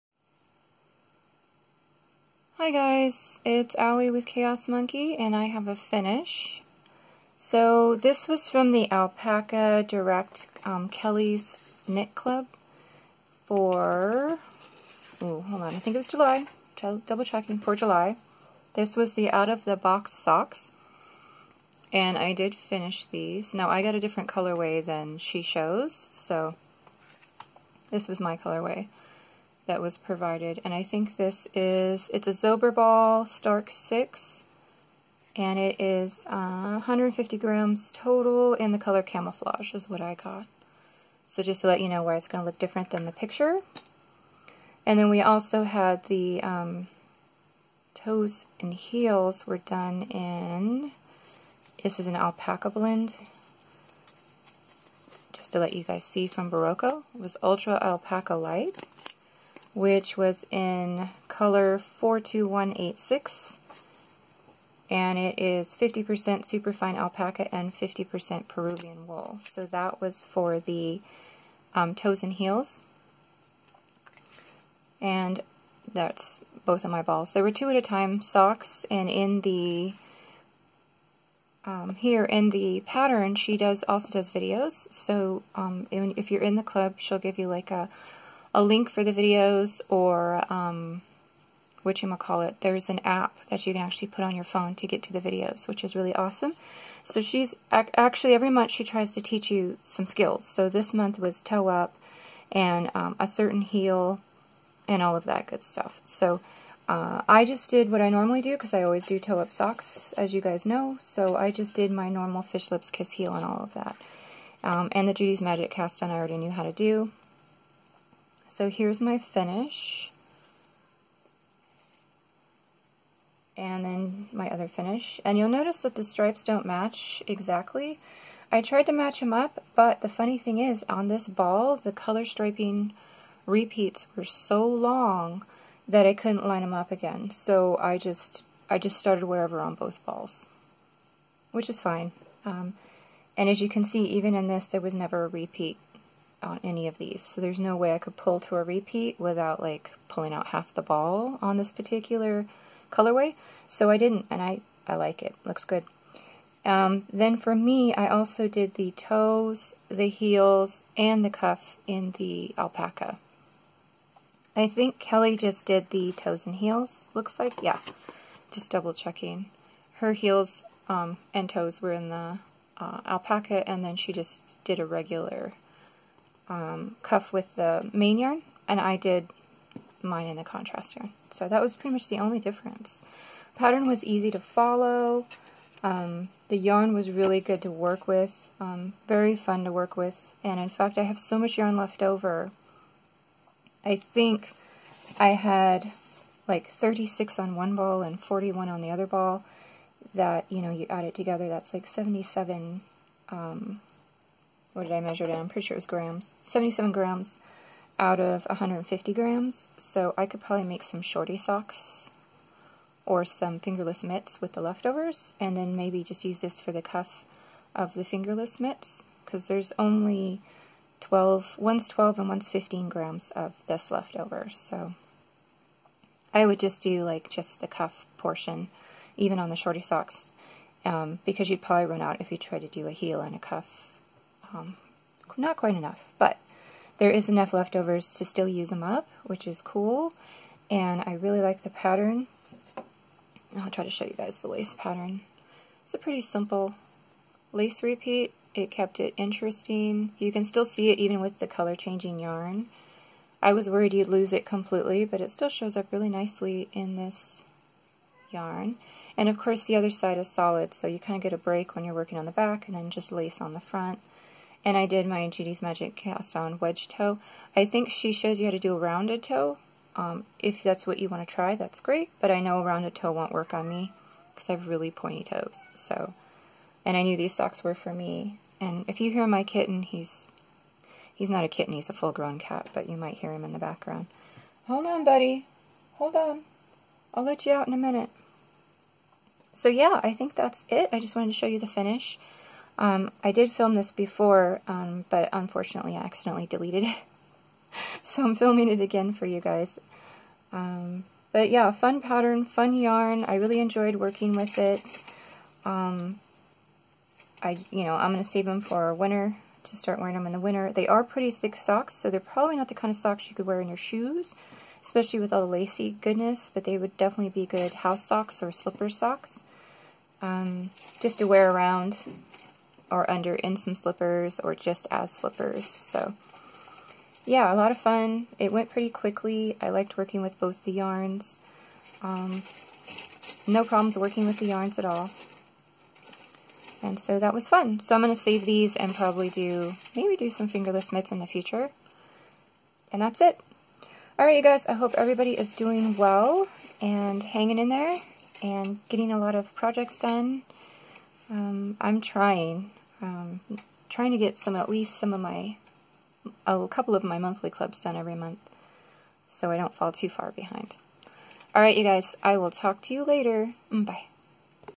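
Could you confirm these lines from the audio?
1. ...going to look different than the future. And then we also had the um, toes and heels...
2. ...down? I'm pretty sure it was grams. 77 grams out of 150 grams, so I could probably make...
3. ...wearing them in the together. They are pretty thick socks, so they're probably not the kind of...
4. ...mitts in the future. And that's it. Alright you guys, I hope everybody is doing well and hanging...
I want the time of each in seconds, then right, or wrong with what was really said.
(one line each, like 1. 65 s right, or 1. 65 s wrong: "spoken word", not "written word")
1. 42 s wrong: "picture", not "future"
2. 205 s right
3. 309 s wrong: "winter", not "together"
4. 340 s right.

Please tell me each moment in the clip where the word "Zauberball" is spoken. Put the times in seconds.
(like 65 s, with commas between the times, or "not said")
32 s.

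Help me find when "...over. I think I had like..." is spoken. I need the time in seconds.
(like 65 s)
192 s.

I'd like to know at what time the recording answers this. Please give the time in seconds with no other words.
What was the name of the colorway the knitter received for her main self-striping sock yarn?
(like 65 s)
39 s.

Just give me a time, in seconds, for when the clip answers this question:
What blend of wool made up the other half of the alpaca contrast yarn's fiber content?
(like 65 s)
68 s.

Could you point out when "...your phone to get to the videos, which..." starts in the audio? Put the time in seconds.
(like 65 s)
94 s.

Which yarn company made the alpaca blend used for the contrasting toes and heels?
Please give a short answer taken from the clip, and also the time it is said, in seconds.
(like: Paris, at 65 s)
Berroco, at 56 s.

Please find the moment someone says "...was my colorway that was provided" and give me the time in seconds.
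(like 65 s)
28 s.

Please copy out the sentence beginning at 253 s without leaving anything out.
I was worried you'd lose it completely, but it still shows up really nicely in this yarn.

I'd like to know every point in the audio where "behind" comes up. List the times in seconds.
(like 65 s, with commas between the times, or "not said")
360 s.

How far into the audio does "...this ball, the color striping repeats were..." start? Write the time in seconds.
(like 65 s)
131 s.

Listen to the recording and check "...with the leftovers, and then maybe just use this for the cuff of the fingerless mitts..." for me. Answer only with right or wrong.
right.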